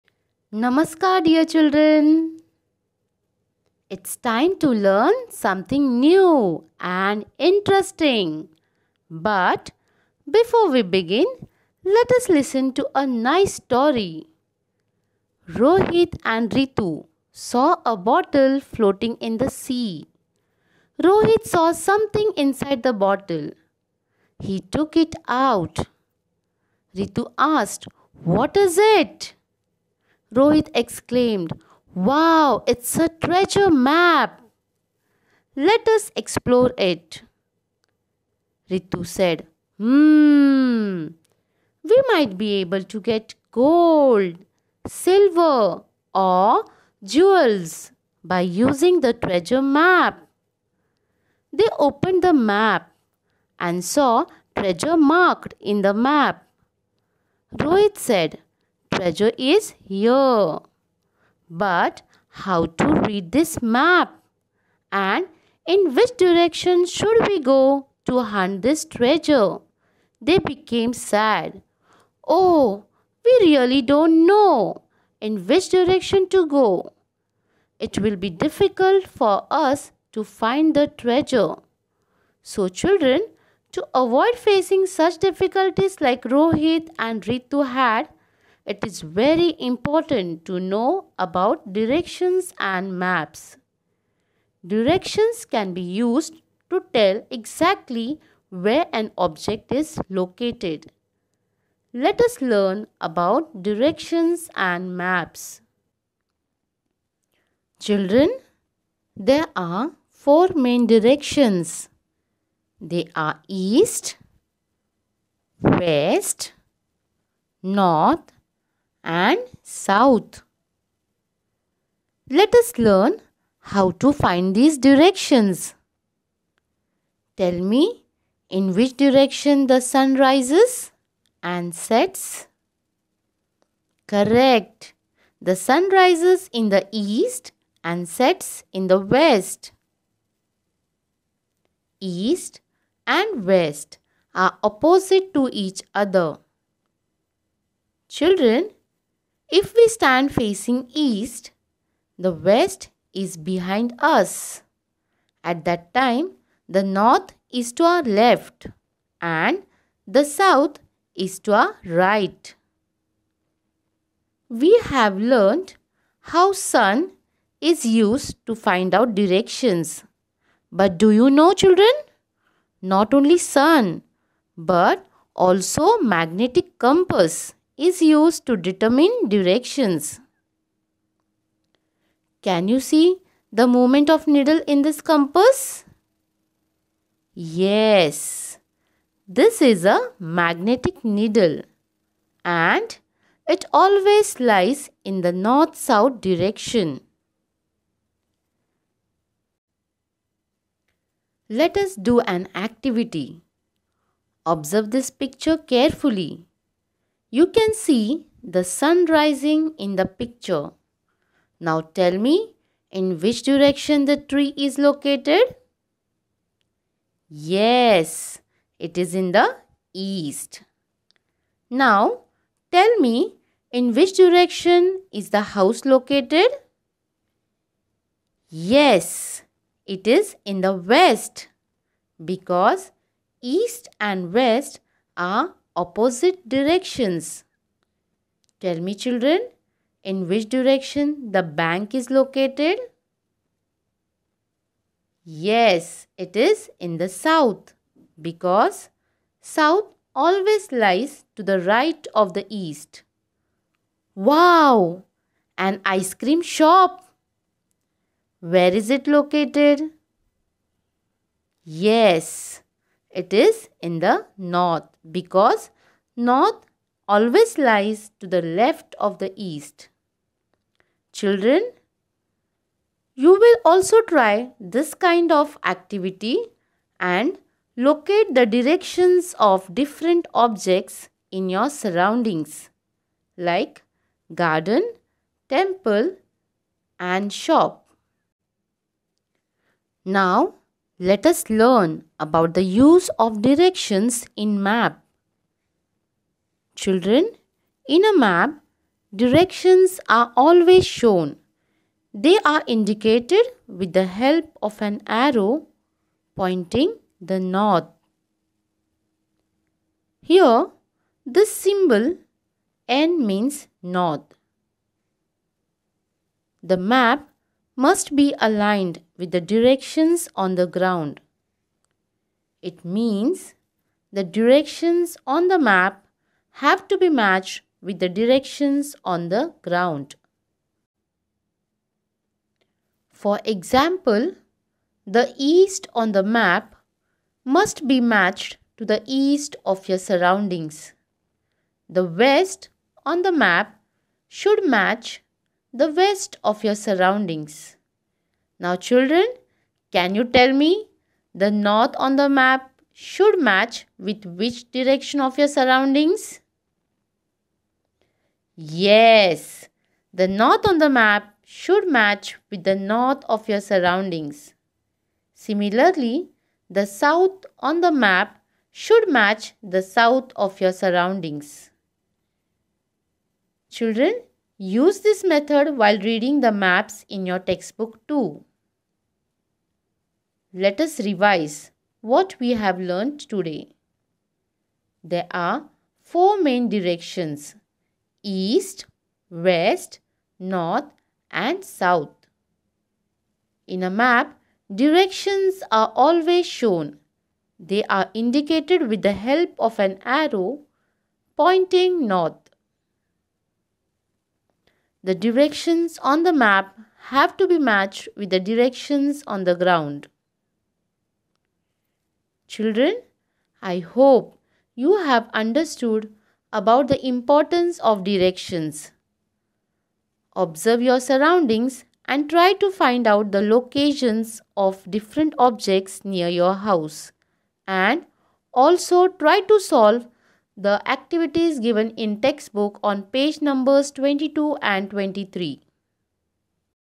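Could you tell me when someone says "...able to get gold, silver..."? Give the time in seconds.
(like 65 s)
42 s.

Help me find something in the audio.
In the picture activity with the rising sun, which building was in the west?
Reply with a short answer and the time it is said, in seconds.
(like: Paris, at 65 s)
The house, at 225 s.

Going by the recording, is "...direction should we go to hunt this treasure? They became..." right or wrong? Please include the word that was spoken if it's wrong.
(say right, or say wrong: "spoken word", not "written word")
right.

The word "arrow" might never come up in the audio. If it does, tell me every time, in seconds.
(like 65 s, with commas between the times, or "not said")
305 s, 400 s.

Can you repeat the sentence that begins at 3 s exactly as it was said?
It's time to learn something new and interesting.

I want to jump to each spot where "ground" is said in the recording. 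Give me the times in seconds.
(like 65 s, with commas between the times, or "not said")
320 s, 329 s, 409 s.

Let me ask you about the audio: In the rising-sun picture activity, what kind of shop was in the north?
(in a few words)
Ice cream shop.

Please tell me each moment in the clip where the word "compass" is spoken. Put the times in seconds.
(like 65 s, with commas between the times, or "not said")
176 s, 185 s.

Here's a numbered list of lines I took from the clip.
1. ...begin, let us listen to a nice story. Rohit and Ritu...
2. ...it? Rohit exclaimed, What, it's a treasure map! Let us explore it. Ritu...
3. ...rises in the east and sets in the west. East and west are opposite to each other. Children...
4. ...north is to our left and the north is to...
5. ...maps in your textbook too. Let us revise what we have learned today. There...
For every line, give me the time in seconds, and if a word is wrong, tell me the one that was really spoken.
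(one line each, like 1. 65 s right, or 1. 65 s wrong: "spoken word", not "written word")
1. 10 s right
2. 28 s wrong: "Wow", not "What"
3. 135 s right
4. 156 s wrong: "south", not "north"
5. 376 s right.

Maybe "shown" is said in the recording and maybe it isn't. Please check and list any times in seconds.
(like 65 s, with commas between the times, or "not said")
300 s, 396 s.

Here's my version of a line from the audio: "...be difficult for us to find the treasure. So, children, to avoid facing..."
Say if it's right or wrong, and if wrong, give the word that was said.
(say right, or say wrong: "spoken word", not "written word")
right.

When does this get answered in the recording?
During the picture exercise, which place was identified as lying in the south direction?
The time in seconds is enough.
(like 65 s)
241 s.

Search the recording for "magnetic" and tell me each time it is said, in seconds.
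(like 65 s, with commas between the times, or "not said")
175 s, 190 s.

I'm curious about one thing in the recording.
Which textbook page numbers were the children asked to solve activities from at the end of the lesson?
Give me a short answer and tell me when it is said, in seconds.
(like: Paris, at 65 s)
22 and 23, at 433 s.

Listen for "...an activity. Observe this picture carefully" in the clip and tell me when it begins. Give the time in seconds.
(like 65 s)
202 s.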